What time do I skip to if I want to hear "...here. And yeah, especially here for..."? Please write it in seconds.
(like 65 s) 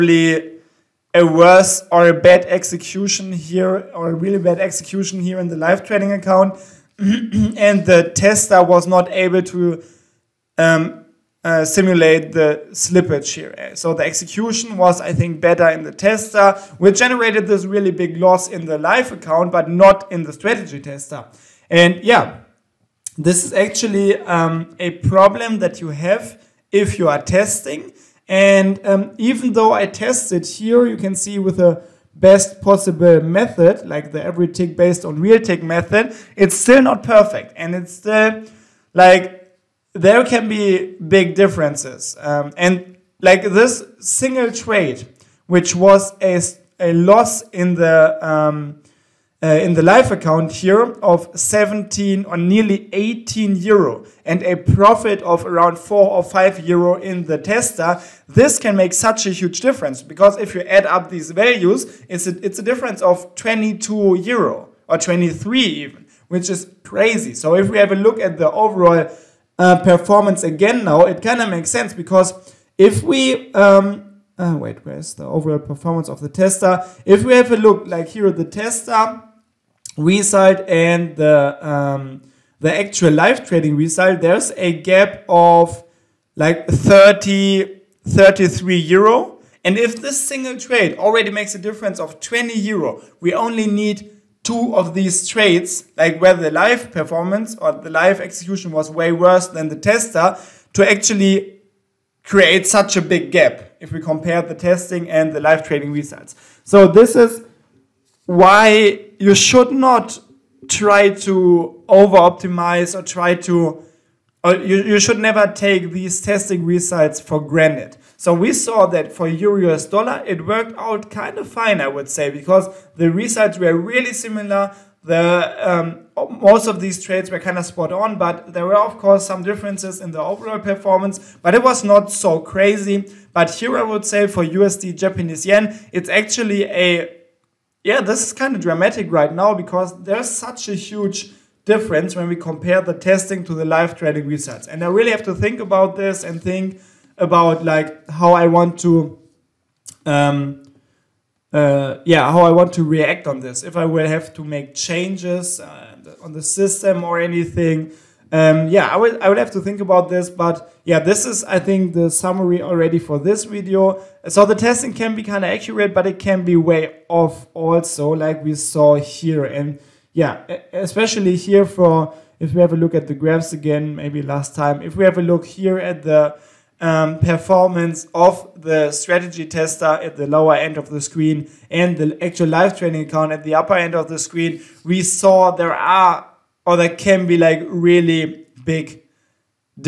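168 s.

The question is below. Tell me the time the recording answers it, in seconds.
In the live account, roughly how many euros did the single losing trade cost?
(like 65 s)
52 s.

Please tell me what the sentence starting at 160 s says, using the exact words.
But yeah, this is I think the summary already for this video.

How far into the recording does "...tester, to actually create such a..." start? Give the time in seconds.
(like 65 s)
99 s.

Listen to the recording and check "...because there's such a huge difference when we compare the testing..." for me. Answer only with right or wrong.
right.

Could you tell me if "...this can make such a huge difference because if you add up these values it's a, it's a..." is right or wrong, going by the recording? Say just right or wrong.
right.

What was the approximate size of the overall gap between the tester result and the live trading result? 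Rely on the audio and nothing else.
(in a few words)
33 euro.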